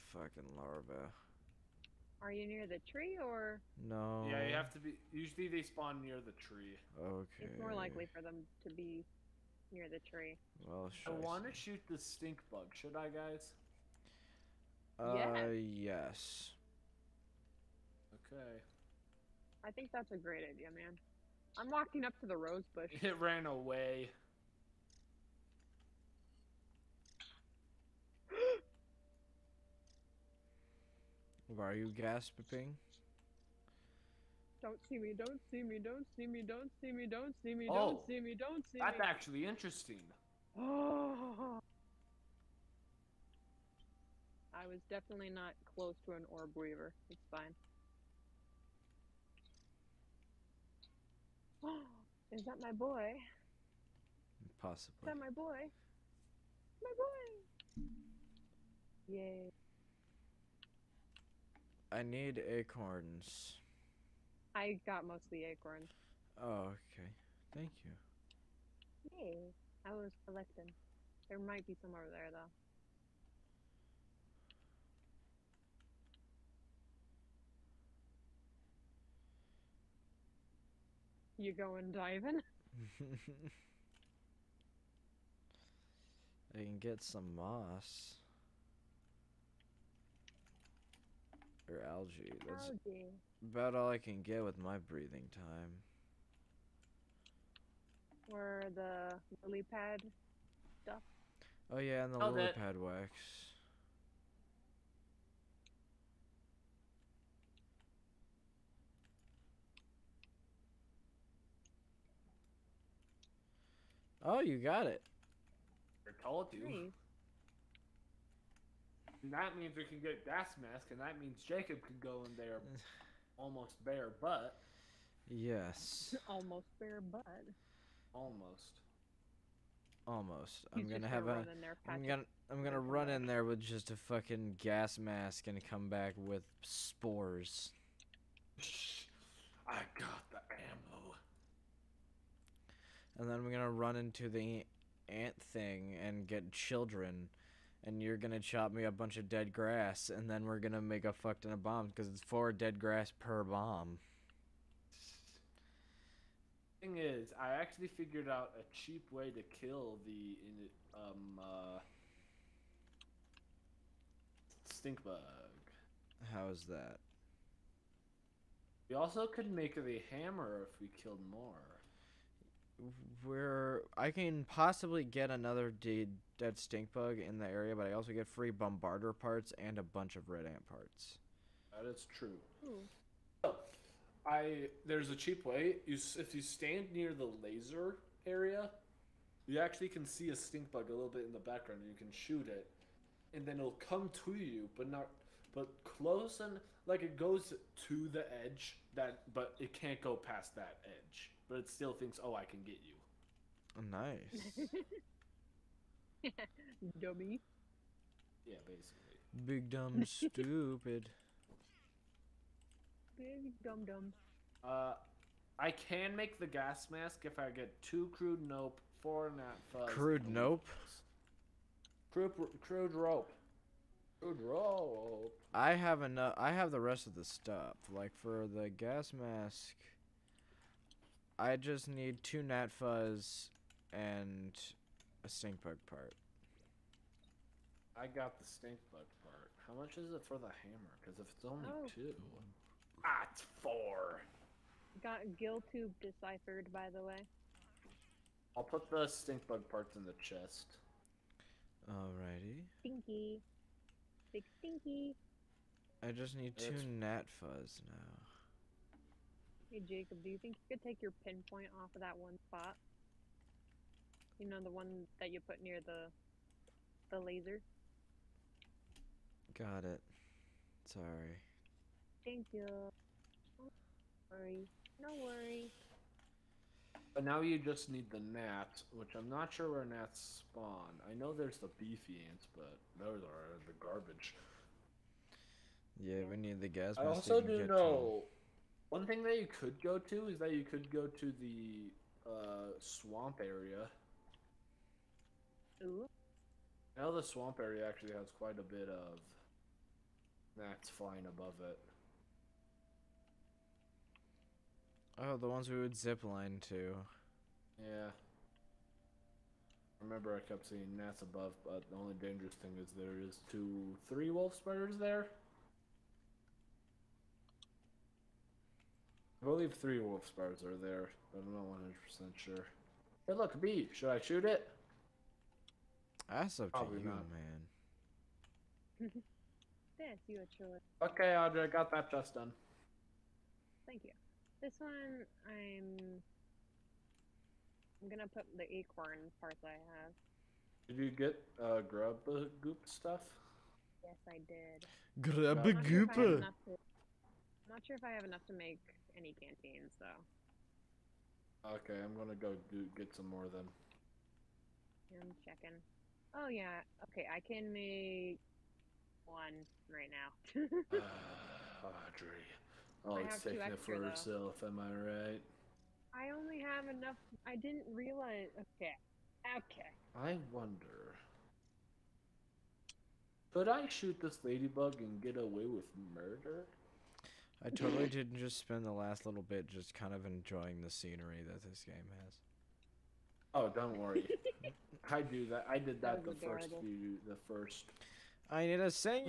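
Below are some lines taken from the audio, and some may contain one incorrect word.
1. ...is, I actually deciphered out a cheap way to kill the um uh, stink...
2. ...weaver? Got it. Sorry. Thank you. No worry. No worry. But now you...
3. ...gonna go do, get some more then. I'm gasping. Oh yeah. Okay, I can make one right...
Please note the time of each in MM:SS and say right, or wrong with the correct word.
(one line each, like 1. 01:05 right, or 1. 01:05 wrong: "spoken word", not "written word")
1. 02:36 wrong: "figured", not "deciphered"
2. 04:27 wrong: "laser", not "weaver"
3. 05:52 wrong: "checking", not "gasping".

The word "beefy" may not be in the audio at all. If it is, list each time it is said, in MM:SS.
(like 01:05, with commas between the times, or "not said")
04:41.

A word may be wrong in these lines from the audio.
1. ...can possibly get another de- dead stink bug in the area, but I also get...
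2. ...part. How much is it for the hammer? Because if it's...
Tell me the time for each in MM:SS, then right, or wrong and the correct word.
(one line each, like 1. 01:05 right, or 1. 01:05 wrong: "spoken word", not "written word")
1. 02:54 right
2. 03:59 right.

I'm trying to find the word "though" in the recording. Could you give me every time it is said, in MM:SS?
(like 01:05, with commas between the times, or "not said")
01:12, 05:49, 06:03.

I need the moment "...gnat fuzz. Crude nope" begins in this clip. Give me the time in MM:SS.
03:39.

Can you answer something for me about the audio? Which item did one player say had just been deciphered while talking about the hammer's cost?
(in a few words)
gill tube.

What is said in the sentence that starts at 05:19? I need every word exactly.
I believe three wolf spars are there, but I'm not 100 percent sure.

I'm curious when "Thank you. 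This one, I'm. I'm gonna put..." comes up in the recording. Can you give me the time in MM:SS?
05:33.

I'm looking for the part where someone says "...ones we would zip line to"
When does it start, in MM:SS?
05:05.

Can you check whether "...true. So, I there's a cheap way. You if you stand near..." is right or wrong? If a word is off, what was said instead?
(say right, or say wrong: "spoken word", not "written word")
right.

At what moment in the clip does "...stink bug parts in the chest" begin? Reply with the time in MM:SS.
04:09.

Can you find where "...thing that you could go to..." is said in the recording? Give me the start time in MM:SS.
04:49.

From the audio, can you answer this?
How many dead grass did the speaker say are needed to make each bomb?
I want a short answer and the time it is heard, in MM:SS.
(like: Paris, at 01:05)
4, at 02:32.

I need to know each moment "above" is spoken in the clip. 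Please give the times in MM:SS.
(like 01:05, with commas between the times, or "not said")
05:01, 05:11.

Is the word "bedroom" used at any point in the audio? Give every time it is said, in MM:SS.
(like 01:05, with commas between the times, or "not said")
not said.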